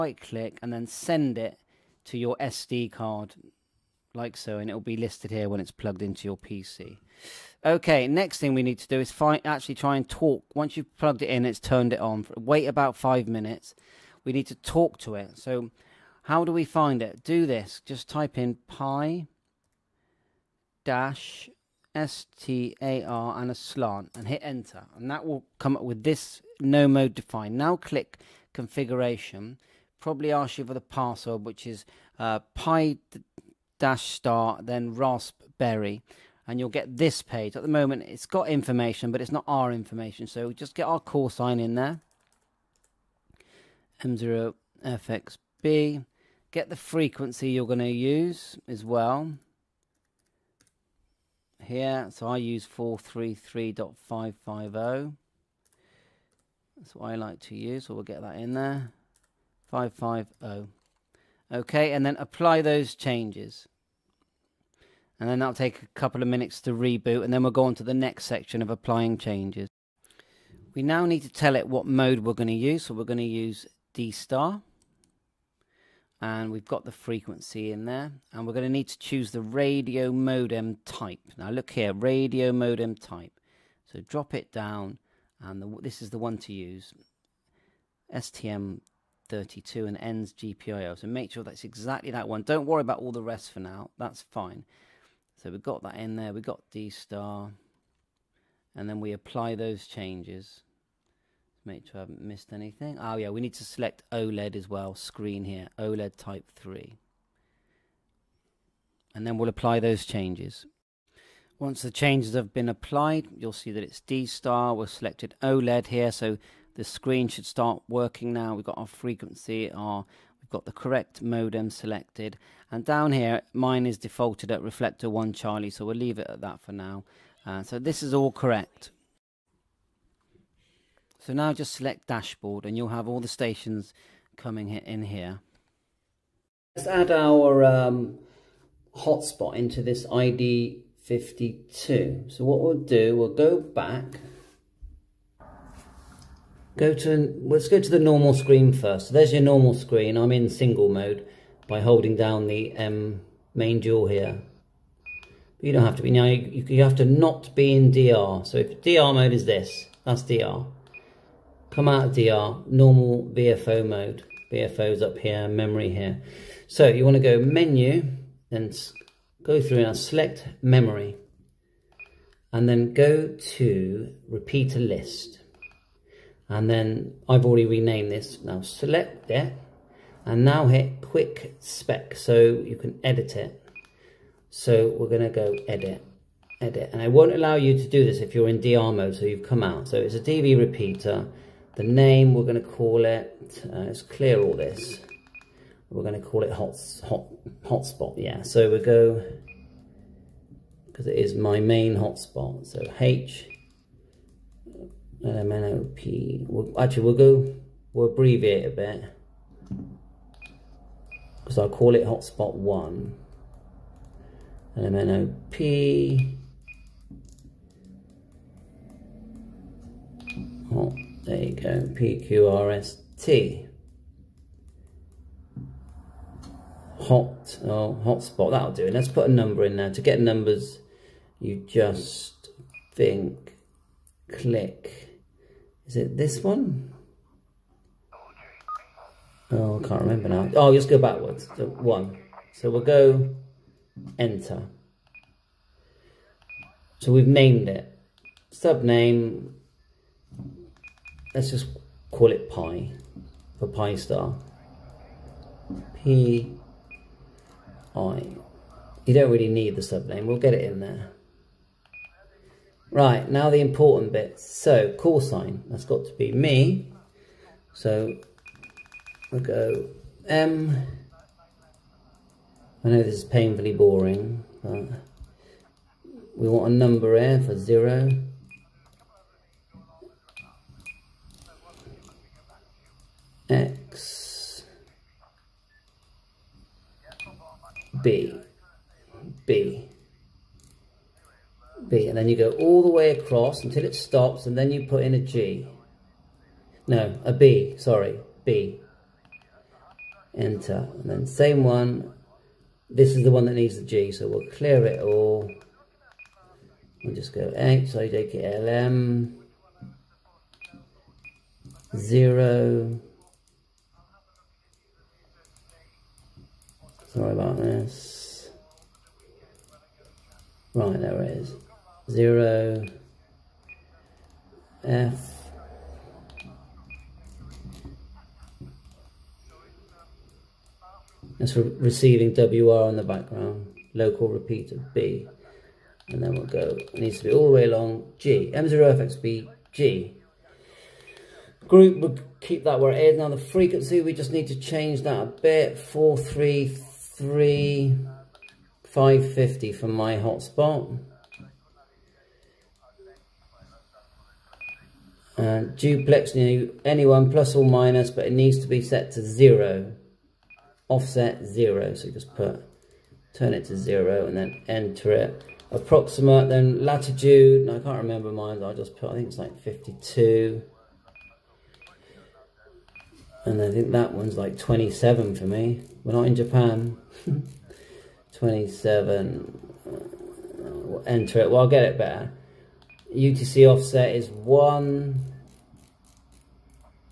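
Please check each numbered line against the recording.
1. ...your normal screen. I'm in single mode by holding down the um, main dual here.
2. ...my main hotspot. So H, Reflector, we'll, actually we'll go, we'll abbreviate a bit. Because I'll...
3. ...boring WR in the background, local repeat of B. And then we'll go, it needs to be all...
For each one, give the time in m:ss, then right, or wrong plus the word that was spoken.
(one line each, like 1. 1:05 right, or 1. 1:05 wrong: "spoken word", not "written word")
1. 2:29 right
2. 3:21 wrong: "LMNOP", not "Reflector"
3. 5:31 wrong: "receiving", not "boring".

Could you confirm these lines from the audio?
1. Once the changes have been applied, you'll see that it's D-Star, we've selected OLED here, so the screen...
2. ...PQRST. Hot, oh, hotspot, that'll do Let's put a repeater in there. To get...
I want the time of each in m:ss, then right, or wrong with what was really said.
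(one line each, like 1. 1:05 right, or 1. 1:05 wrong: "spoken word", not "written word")
1. 1:51 right
2. 3:41 wrong: "number", not "repeater".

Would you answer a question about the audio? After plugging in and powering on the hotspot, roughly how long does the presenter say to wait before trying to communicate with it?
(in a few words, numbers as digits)
5 minutes.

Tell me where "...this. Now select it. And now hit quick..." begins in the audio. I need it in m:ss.
2:58.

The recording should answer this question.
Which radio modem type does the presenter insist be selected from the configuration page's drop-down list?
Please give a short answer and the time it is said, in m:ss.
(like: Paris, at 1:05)
STM32 and ends GPIO, at 1:28.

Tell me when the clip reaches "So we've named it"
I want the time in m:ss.
4:06.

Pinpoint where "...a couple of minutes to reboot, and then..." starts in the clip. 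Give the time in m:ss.
1:05.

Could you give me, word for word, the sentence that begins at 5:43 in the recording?
Now the frequency, we just need to change that a bit, 4, 3, three 550 for my hotspot.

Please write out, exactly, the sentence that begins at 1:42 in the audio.
Oh yeah, we need to select OLED as well, screen here, OLED type 3.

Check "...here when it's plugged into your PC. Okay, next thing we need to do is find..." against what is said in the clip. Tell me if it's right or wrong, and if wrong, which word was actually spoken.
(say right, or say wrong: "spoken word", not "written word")
right.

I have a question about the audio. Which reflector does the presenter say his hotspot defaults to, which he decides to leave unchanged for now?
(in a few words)
Reflector 1 Charlie.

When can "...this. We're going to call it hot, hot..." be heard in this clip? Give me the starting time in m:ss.
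3:14.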